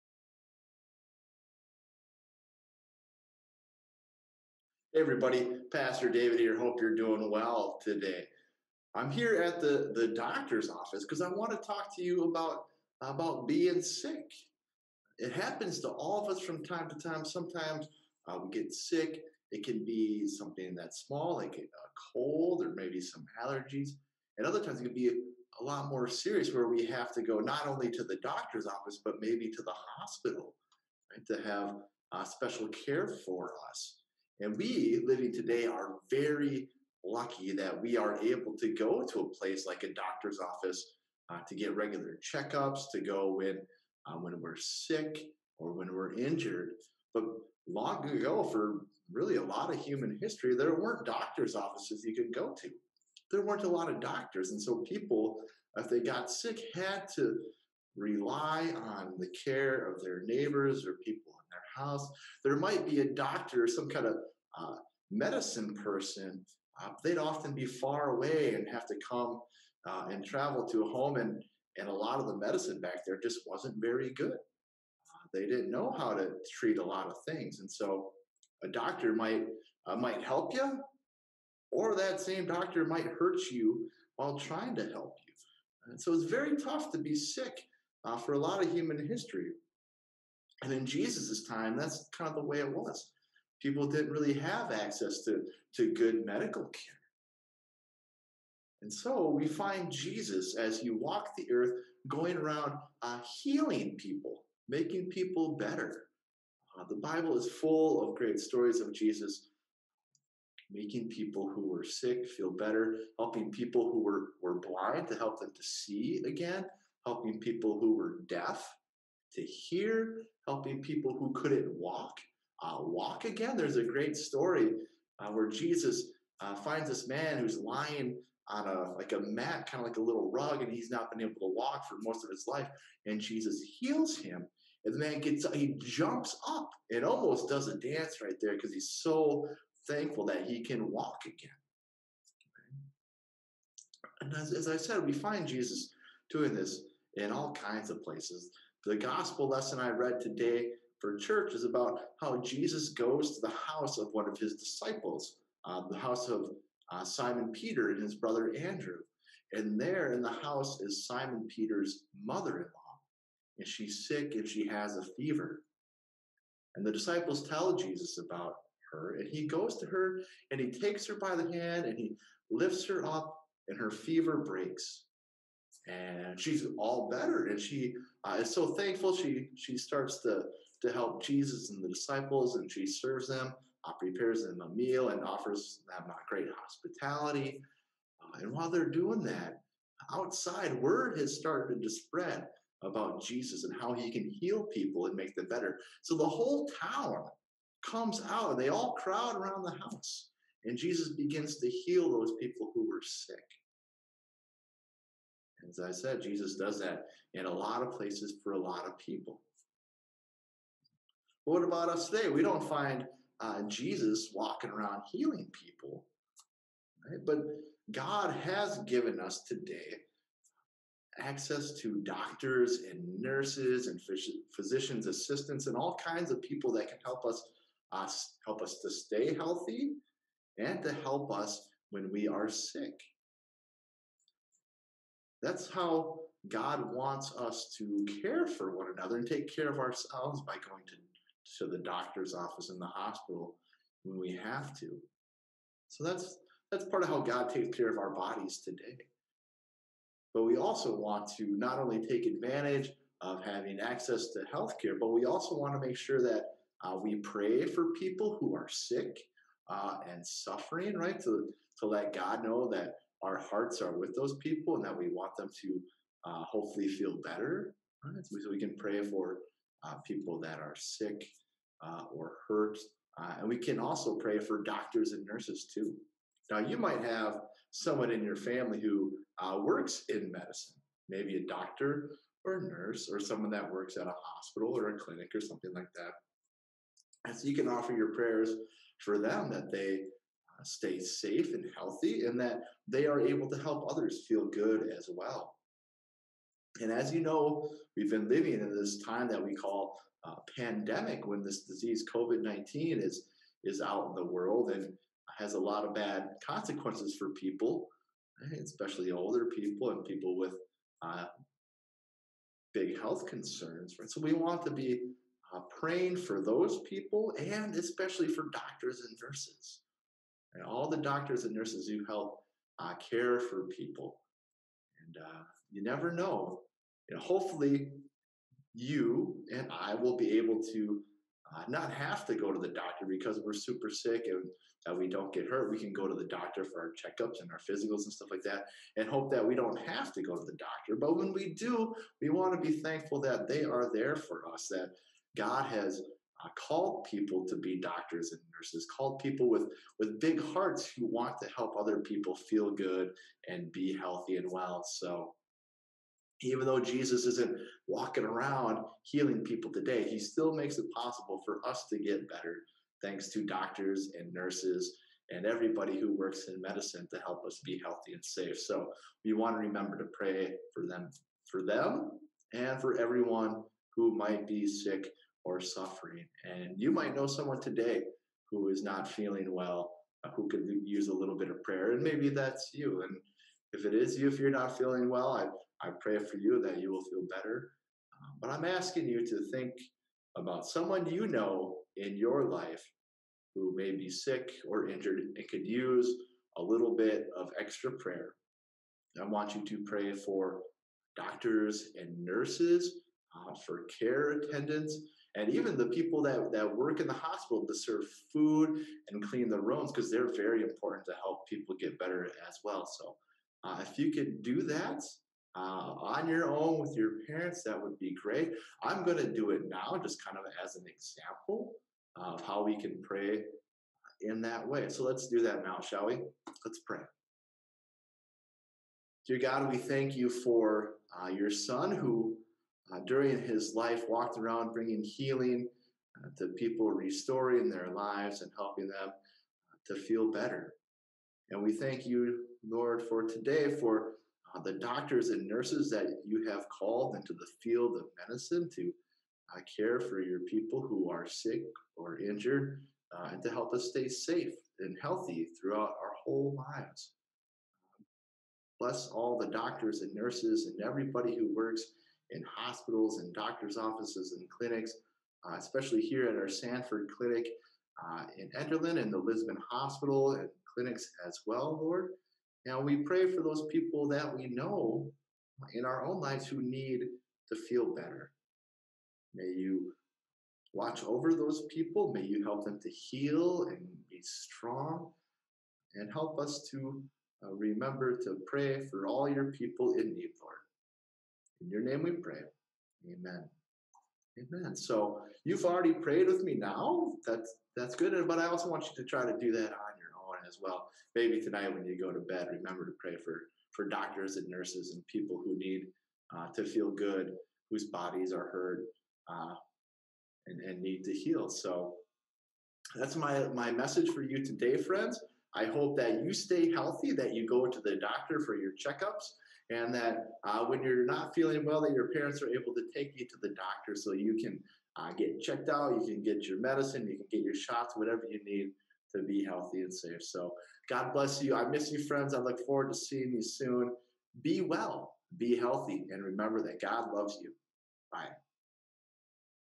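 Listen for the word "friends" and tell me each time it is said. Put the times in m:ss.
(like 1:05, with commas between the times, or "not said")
8:34, 8:52.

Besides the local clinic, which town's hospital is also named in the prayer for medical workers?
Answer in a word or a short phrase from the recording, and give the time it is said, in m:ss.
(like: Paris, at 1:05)
Lisbon, at 7:49.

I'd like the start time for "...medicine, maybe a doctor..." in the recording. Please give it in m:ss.
4:40.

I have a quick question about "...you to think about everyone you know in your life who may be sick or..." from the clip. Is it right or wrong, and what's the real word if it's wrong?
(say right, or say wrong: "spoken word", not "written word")
wrong: "someone", not "everyone".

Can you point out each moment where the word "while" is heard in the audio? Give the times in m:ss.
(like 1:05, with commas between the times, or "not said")
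1:24, 3:08.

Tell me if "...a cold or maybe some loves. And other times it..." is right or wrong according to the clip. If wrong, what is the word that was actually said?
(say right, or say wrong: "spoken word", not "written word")
wrong: "allergies", not "loves".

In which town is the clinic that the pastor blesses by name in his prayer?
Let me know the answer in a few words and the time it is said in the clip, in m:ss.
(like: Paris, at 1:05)
Enderlin, at 7:48.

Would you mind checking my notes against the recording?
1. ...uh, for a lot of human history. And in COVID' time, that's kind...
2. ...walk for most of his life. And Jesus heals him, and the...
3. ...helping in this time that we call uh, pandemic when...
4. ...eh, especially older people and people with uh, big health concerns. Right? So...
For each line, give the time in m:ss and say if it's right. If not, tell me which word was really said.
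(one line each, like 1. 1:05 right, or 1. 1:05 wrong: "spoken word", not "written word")
1. 1:28 wrong: "Jesus", not "COVID"
2. 2:11 right
3. 4:58 wrong: "living", not "helping"
4. 5:08 right.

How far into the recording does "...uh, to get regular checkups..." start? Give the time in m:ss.
0:41.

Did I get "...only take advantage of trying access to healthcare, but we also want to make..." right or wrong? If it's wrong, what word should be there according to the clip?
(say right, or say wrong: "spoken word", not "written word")
wrong: "having", not "trying".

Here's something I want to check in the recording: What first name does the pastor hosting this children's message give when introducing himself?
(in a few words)
David.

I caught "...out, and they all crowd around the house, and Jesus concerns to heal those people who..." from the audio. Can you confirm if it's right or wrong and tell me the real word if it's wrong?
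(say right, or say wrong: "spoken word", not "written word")
wrong: "begins", not "concerns".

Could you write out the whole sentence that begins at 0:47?
But long ago, for really a lot of human history, there weren't doctors' offices you could go to.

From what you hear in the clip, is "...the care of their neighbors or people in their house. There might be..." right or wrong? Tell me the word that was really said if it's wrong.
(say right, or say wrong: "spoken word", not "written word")
right.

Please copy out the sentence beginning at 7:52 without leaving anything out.
And we pray for those people that we know in our own lives who need to feel better.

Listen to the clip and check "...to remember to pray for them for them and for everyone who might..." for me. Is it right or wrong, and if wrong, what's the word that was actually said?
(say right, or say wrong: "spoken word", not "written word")
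right.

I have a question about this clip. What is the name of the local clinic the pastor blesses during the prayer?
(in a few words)
Sanford Clinic.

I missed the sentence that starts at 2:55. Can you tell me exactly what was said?
And she's all better, and she uh, is so thankful.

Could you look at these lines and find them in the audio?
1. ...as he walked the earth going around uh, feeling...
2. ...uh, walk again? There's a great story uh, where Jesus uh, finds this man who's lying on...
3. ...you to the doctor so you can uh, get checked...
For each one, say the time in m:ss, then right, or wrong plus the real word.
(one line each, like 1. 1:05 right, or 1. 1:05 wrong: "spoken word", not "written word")
1. 1:40 wrong: "healing", not "feeling"
2. 2:02 right
3. 8:43 right.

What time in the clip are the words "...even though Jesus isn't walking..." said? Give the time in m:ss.
5:56.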